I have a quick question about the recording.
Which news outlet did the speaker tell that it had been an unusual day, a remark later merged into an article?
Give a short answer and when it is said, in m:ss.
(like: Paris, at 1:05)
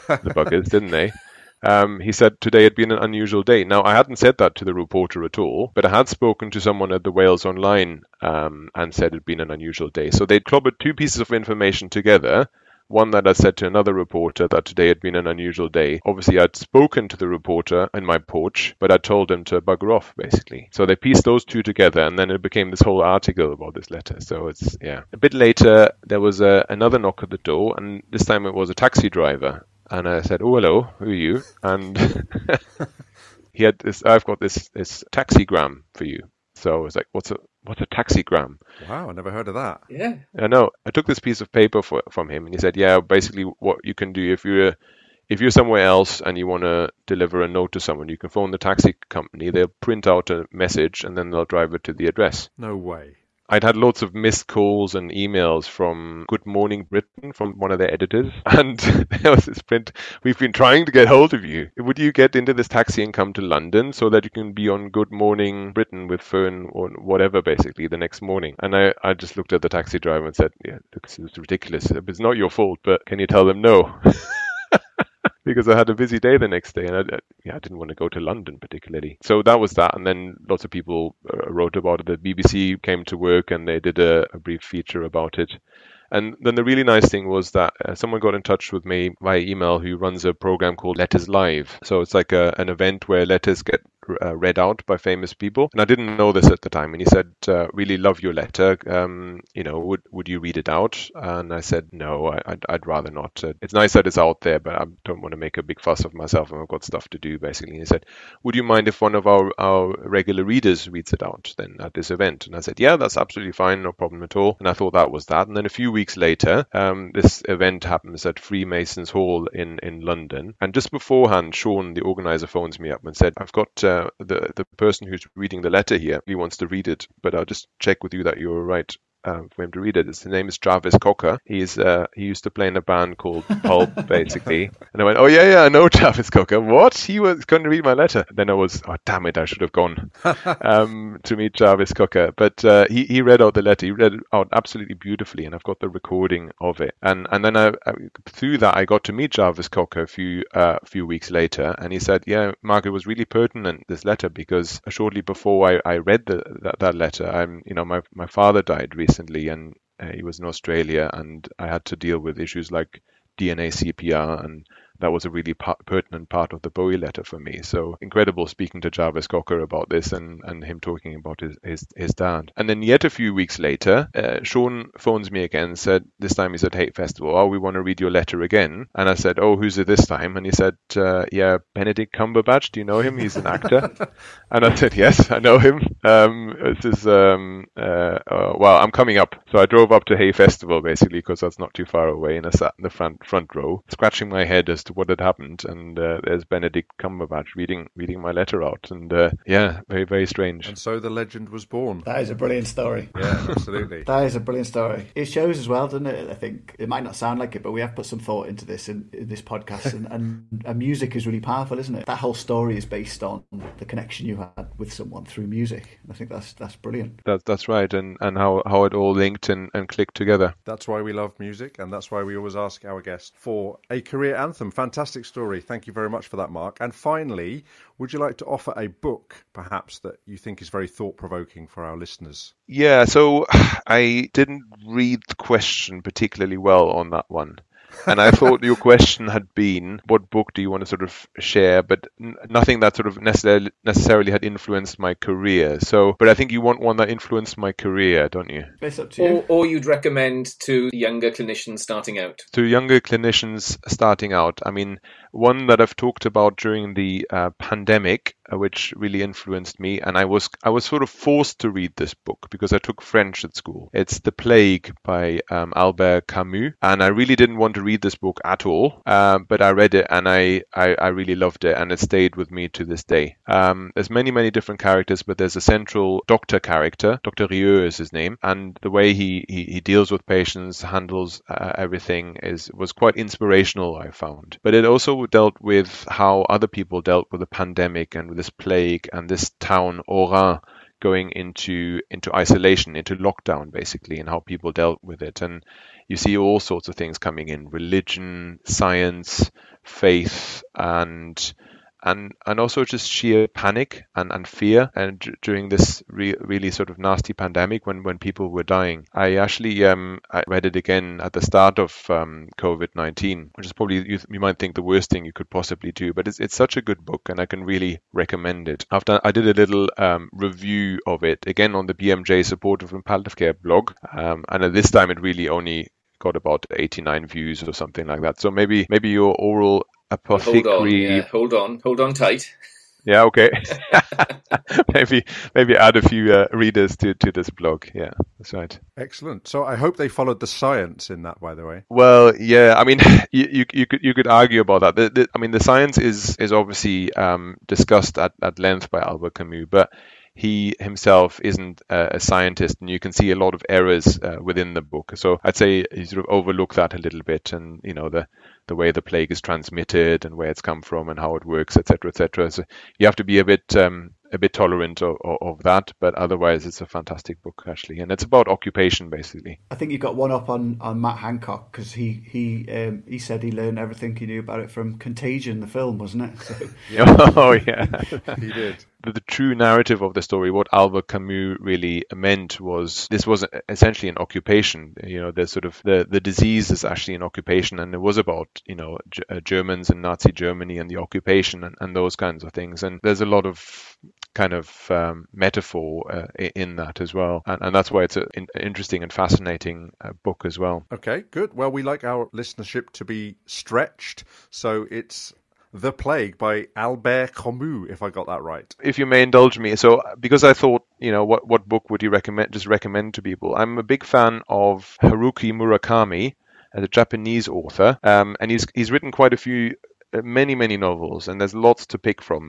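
Wales Online, at 0:07.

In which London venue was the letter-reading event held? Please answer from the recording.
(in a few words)
Freemasons Hall.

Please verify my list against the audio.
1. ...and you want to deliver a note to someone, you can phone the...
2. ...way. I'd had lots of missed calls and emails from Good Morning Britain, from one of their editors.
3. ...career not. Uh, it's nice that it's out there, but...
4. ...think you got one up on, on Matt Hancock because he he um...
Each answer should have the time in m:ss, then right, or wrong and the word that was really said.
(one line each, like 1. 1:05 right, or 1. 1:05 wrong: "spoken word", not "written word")
1. 0:46 right
2. 0:52 right
3. 1:42 wrong: "rather", not "career"
4. 6:09 right.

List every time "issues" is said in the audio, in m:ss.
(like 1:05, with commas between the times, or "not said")
2:42.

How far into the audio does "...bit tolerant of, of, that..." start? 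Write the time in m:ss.
6:04.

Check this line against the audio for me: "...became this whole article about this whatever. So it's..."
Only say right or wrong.
wrong.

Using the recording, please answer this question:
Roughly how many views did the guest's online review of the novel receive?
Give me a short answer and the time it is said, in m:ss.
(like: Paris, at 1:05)
89, at 5:26.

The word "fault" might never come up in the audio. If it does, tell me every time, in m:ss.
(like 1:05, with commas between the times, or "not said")
1:12.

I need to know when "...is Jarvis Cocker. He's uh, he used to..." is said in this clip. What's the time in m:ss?
2:10.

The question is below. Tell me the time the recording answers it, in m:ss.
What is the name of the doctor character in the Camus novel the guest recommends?
4:37.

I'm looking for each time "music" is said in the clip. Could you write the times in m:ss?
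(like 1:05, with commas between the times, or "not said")
3:30, 3:35, 3:41.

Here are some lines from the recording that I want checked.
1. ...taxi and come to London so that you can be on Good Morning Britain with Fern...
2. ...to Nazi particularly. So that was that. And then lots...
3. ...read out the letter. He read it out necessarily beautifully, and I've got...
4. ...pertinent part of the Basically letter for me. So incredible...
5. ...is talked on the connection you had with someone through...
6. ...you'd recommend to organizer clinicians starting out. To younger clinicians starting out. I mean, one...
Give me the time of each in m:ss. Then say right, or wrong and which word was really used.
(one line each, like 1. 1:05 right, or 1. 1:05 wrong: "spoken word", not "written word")
1. 1:02 right
2. 1:18 wrong: "London", not "Nazi"
3. 2:23 wrong: "absolutely", not "necessarily"
4. 2:45 wrong: "Bowie", not "Basically"
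5. 3:32 wrong: "based", not "talked"
6. 4:09 wrong: "younger", not "organizer".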